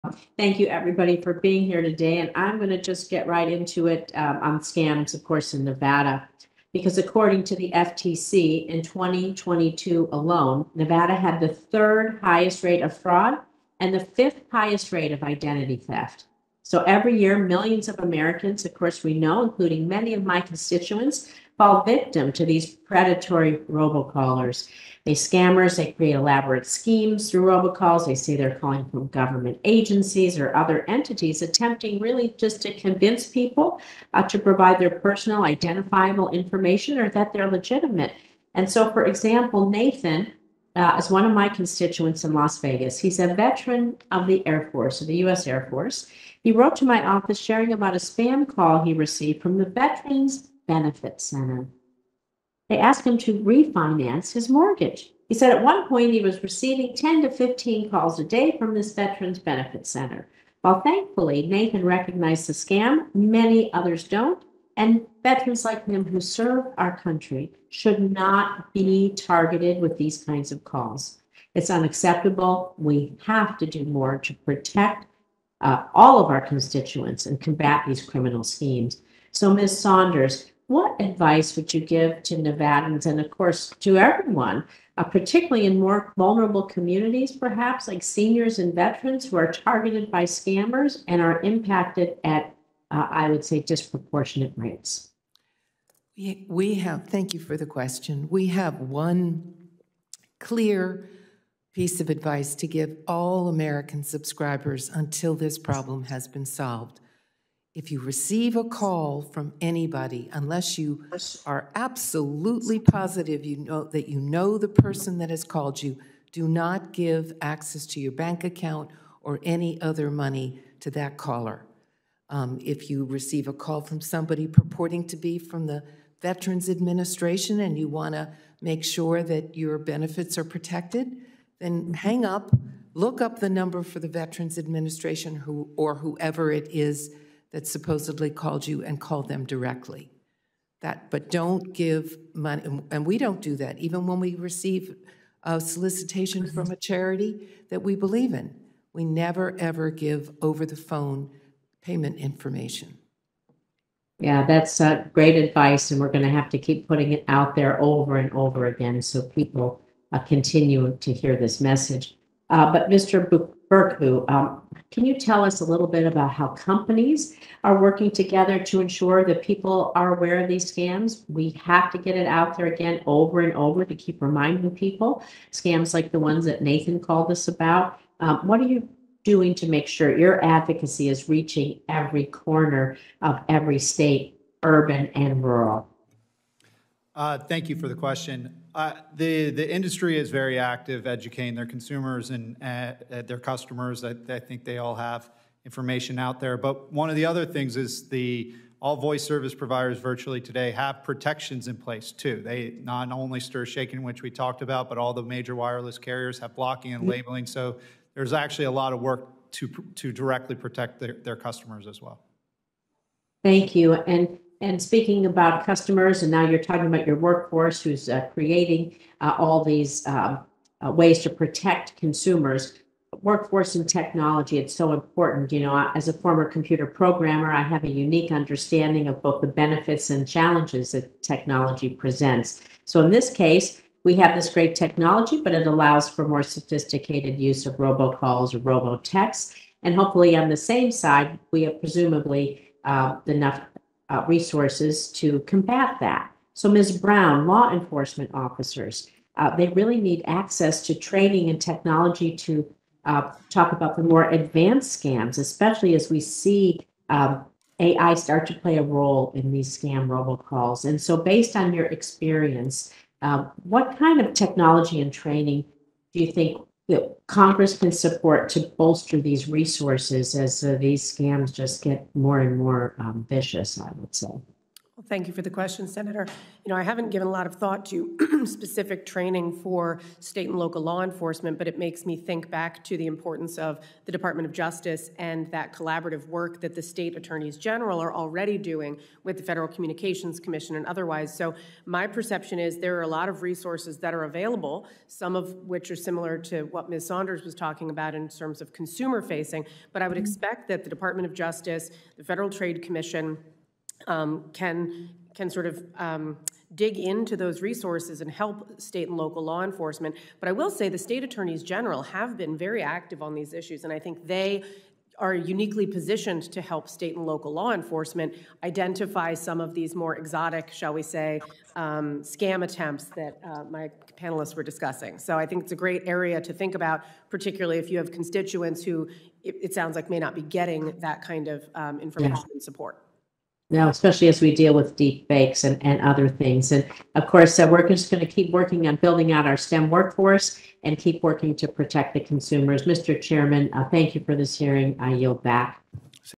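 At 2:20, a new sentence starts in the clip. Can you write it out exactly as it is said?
That, but don't give money, and we don't do that.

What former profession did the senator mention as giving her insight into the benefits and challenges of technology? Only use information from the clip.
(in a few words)
computer programmer.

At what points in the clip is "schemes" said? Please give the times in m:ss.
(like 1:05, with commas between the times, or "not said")
0:26, 1:18.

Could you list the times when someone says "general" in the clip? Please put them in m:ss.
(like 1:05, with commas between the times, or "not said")
4:47, 5:11.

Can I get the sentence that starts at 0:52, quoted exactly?
They asked him to refinance his mortgage.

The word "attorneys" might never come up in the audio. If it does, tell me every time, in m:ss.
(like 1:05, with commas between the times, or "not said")
4:47, 5:11.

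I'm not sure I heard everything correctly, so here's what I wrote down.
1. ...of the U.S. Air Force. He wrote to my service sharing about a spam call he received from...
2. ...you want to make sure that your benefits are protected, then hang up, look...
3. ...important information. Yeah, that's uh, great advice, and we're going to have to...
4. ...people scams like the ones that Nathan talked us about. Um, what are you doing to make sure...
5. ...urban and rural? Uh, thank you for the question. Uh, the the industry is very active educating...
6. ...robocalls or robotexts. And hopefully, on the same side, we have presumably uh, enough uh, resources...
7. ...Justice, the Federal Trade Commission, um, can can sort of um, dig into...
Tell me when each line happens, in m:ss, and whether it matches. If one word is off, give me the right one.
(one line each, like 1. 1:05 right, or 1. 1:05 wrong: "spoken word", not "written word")
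1. 0:45 wrong: "office", not "service"
2. 2:07 right
3. 2:31 wrong: "payment", not "important"
4. 2:54 wrong: "called", not "talked"
5. 3:04 right
6. 3:57 right
7. 5:01 right.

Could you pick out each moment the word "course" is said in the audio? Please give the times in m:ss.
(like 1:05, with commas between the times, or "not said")
0:05, 0:18, 1:23, 5:37.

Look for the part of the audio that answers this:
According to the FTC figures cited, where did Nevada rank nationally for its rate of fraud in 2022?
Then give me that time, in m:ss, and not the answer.
0:11.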